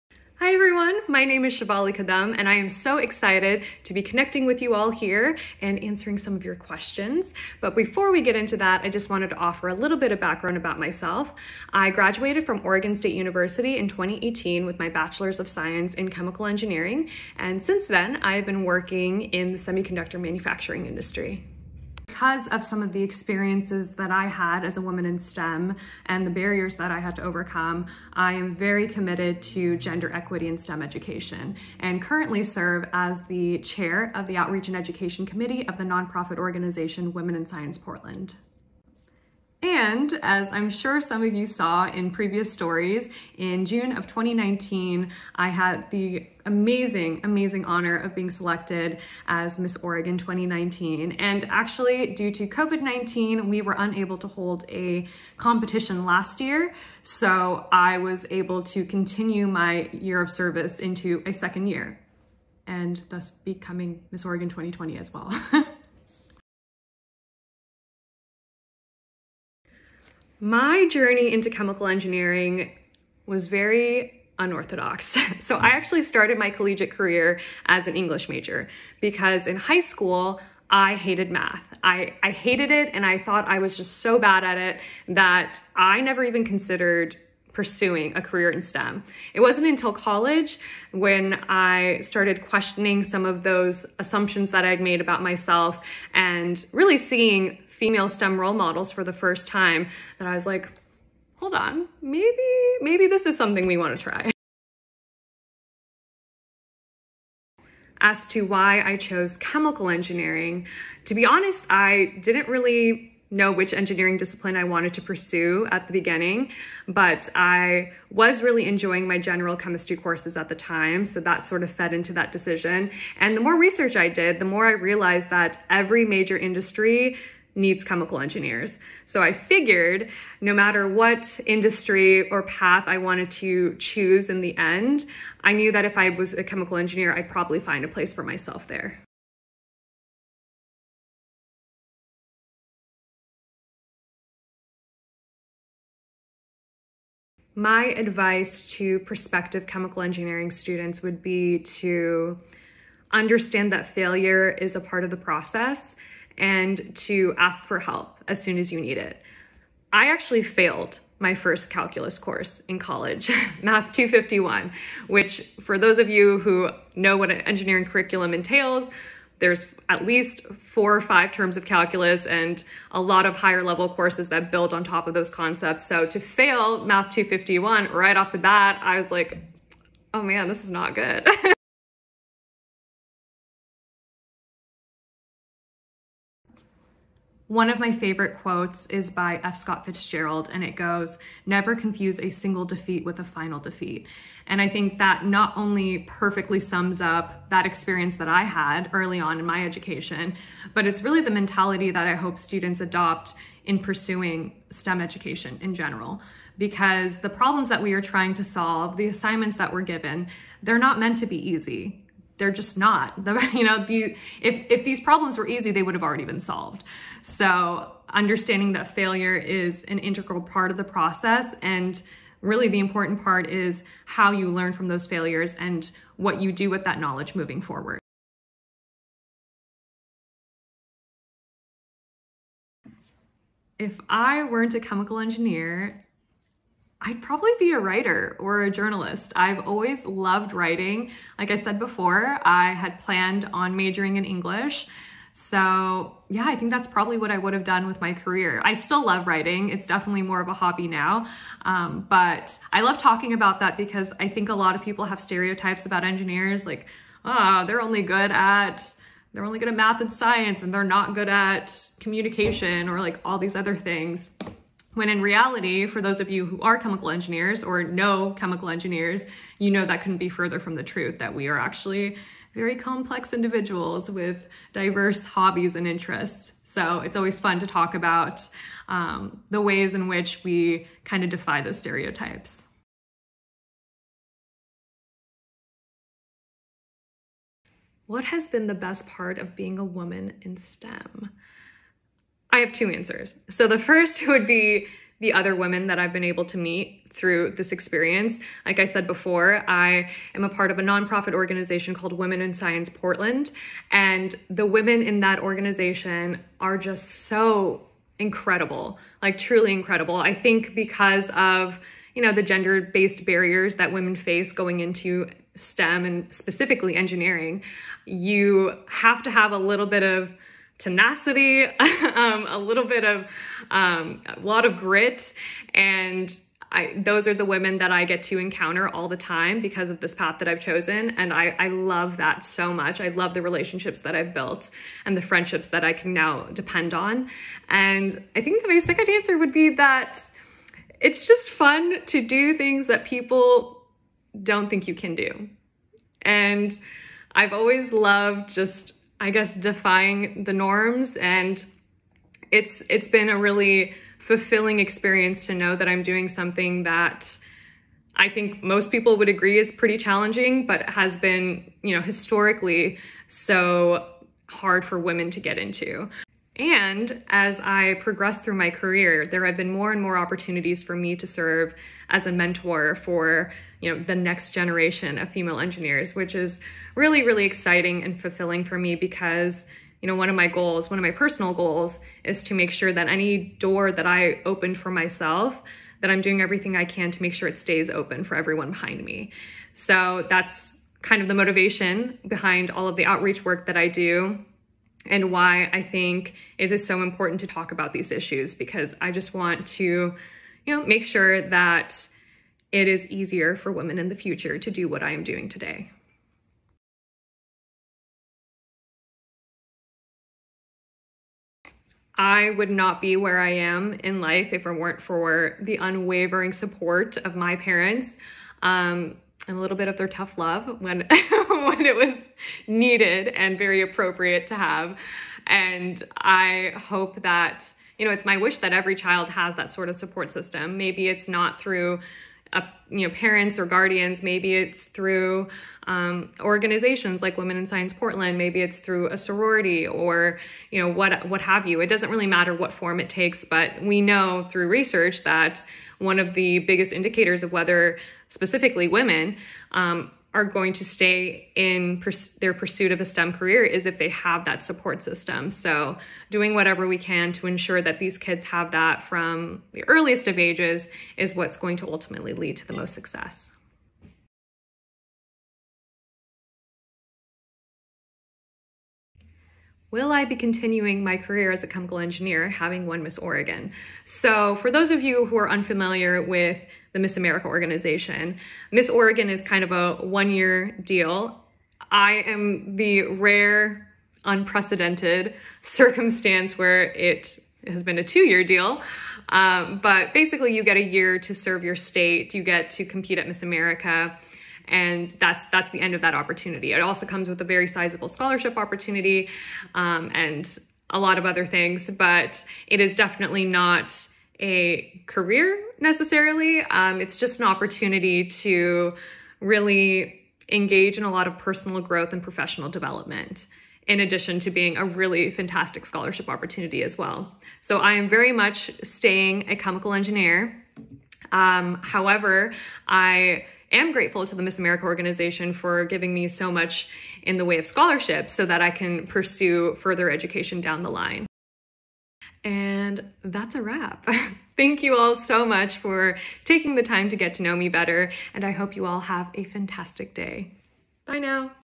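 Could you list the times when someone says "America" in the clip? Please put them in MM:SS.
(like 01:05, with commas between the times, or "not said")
07:57, 08:13, 08:44.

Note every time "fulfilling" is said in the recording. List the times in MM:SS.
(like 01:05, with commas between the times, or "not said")
05:54, 06:18.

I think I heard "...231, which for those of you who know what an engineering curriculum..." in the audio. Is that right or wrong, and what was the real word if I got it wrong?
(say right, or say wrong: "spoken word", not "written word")
wrong: "251", not "231".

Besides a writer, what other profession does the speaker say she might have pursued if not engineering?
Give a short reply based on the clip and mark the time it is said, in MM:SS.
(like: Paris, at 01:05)
journalist, at 03:58.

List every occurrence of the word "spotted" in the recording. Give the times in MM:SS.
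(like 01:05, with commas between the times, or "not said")
not said.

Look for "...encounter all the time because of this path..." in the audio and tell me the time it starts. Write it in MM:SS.
05:28.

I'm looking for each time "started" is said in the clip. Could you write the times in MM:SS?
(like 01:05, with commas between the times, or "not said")
01:16, 01:32.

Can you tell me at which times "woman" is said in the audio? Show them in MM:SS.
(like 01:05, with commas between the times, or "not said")
00:24, 04:49.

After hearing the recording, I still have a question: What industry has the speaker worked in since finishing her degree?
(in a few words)
semiconductor manufacturing.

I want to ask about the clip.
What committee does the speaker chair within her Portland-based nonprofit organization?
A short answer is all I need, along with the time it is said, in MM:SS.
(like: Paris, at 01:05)
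Outreach and Education Committee, at 00:34.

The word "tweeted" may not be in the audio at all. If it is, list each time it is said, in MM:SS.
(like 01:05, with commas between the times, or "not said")
not said.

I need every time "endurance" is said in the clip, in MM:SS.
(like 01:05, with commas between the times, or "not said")
not said.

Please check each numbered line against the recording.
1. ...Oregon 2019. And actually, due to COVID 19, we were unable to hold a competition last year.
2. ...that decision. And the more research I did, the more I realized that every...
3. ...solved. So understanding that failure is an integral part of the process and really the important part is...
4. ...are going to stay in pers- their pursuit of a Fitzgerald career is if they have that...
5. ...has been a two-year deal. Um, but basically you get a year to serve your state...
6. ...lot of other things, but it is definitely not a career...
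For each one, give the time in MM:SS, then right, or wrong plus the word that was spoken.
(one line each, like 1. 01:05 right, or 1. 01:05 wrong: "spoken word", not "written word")
1. 00:49 right
2. 02:02 right
3. 03:36 right
4. 07:30 wrong: "STEM", not "Fitzgerald"
5. 08:07 right
6. 08:20 right.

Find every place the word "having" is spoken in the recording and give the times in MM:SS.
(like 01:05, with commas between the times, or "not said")
07:52.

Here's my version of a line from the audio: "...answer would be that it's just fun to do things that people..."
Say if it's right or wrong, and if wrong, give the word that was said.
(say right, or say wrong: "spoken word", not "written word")
right.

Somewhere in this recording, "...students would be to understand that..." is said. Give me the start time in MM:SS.
02:30.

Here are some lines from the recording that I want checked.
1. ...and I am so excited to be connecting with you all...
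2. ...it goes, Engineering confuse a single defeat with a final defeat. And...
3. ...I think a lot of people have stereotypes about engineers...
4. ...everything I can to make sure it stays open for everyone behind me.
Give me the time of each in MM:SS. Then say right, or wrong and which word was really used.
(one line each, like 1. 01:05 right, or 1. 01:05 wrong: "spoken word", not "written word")
1. 00:02 right
2. 03:10 wrong: "Never", not "Engineering"
3. 04:14 right
4. 06:26 right.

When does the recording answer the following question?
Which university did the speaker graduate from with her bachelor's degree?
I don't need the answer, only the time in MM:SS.
00:12.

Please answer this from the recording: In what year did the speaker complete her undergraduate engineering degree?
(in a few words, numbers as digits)
2018.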